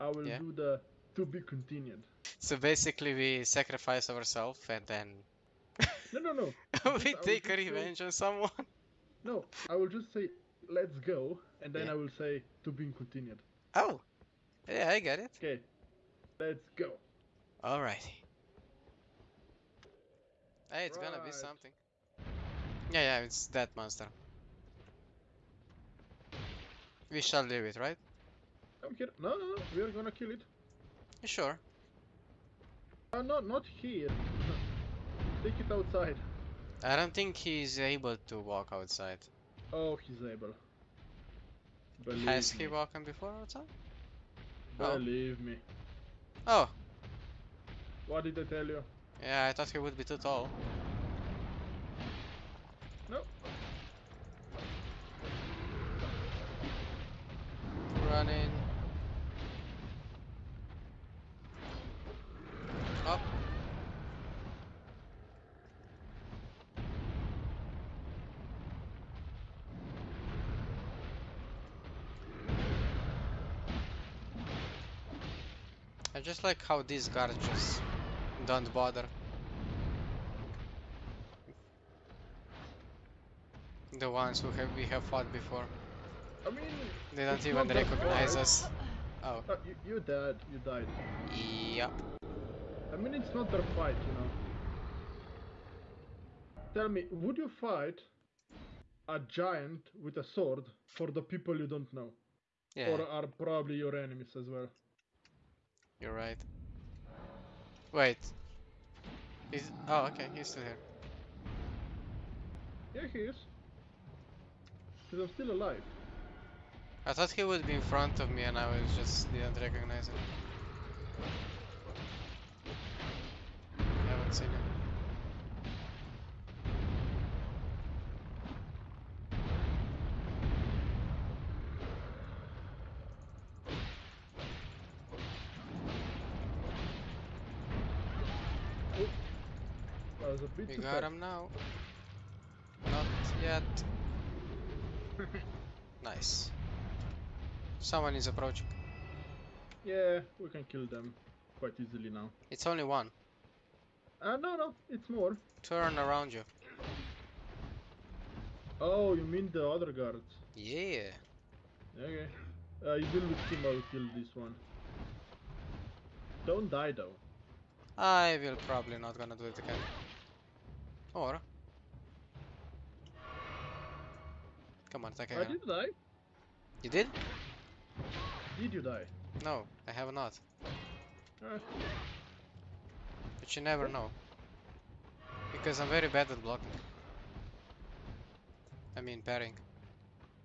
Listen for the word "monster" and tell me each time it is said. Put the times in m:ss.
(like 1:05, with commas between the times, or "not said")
0:23.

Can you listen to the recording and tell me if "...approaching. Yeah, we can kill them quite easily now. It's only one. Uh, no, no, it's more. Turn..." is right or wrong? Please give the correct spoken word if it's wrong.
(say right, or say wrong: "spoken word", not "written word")
right.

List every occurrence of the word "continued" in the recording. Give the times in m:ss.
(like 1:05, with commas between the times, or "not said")
0:01, 0:12.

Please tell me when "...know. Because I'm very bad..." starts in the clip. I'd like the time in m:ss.
3:03.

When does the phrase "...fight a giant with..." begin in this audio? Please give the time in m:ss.
1:37.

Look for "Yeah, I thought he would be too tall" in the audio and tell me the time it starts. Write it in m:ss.
0:49.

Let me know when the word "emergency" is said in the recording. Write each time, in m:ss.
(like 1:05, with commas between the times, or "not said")
not said.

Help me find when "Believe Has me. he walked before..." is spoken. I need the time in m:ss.
0:42.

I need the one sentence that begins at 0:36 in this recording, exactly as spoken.
I don't think he's able to walk outside.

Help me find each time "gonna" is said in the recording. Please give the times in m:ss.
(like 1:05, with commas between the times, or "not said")
0:21, 0:29, 2:49.